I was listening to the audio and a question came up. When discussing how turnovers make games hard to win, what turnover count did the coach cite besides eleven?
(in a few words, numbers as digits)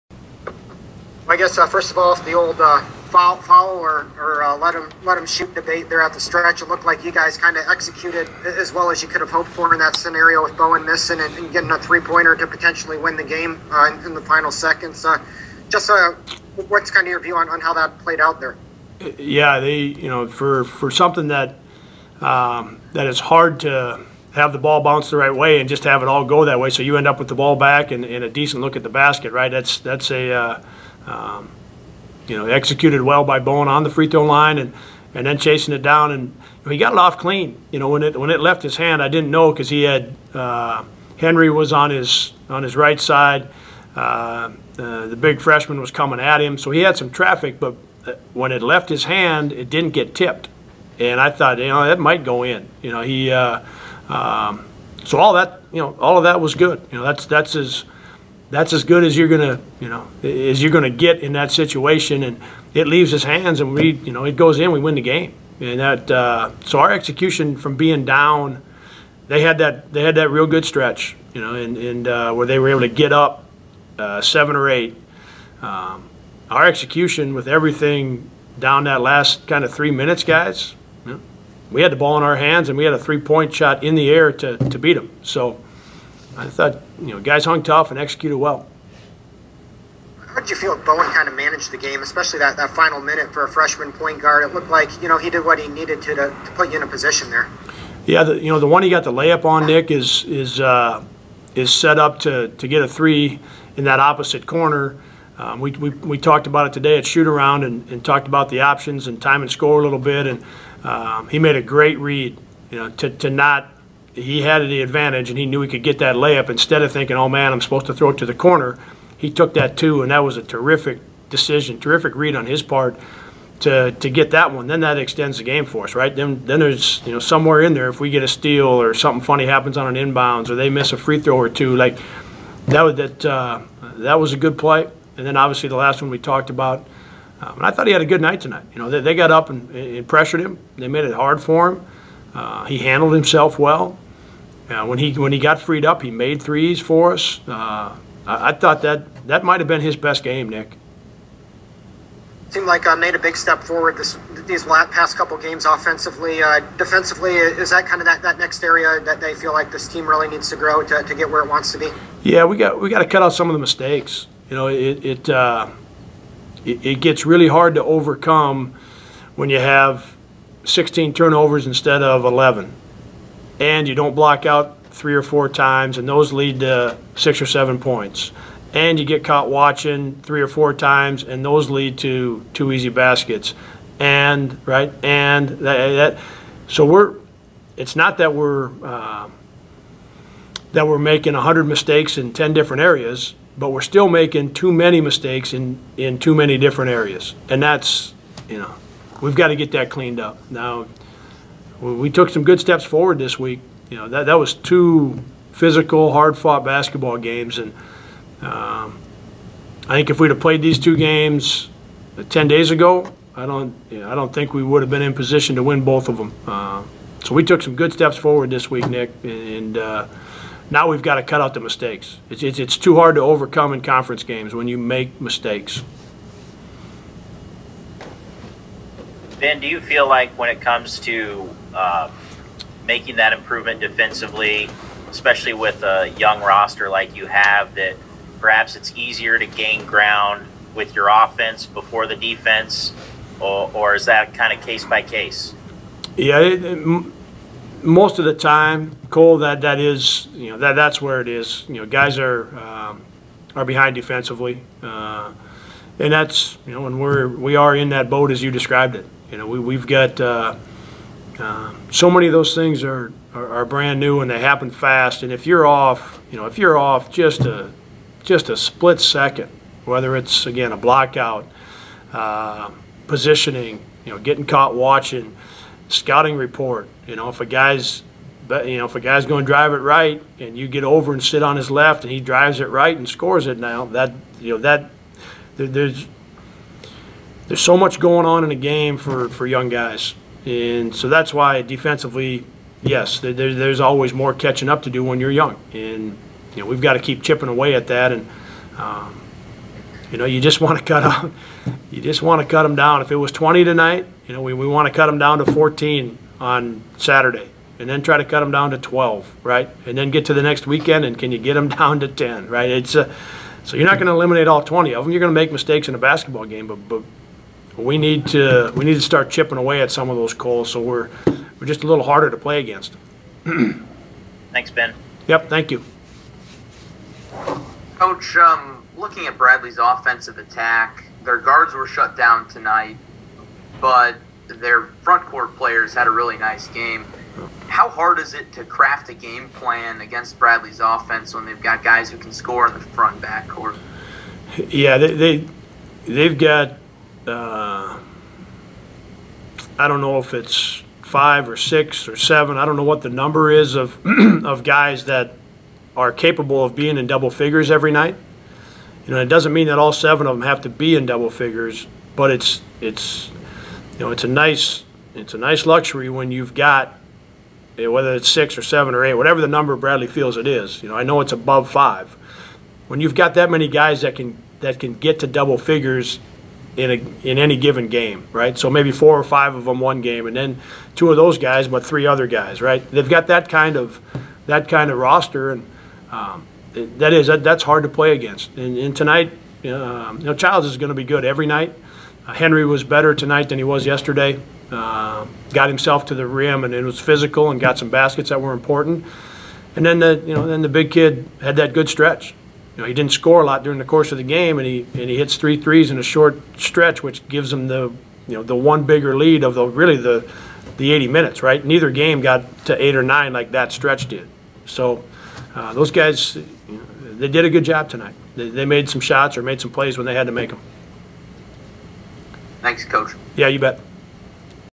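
16.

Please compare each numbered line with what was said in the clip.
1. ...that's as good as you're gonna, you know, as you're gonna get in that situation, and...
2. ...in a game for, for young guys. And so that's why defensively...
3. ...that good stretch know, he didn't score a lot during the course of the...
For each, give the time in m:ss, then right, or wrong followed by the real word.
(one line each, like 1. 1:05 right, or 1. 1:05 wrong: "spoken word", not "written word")
1. 0:58 right
2. 4:48 right
3. 6:41 right.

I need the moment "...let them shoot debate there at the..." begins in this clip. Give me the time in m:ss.
0:05.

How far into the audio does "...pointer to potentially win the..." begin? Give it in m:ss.
0:12.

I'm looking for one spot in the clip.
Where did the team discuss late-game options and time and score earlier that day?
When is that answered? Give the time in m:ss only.
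1:47.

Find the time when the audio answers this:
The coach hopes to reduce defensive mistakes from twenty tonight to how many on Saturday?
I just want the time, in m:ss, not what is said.
5:05.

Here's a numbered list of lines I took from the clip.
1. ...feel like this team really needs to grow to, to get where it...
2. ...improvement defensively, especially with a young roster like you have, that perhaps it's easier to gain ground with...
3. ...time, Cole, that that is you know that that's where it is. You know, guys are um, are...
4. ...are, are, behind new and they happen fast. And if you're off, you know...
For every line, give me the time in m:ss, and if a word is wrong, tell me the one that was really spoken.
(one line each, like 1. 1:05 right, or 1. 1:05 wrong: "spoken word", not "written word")
1. 2:39 right
2. 3:53 right
3. 4:08 right
4. 4:23 wrong: "brand", not "behind".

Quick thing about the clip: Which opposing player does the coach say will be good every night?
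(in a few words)
Childs.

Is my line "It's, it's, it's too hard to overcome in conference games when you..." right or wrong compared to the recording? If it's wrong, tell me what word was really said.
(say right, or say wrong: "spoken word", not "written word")
right.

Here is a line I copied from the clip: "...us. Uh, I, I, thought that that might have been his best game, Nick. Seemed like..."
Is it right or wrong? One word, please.
right.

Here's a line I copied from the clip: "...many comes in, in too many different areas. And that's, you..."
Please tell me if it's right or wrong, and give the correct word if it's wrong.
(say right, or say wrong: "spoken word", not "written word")
wrong: "mistakes", not "comes".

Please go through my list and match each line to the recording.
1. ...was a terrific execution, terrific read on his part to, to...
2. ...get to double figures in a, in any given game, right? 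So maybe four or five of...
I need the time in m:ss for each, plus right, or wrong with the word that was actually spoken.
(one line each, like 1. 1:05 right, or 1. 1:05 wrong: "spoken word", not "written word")
1. 2:00 wrong: "decision", not "execution"
2. 6:14 right.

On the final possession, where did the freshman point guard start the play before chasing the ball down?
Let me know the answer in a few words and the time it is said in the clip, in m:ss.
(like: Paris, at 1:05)
free throw line, at 0:33.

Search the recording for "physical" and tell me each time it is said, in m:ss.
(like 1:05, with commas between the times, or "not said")
3:25, 6:36.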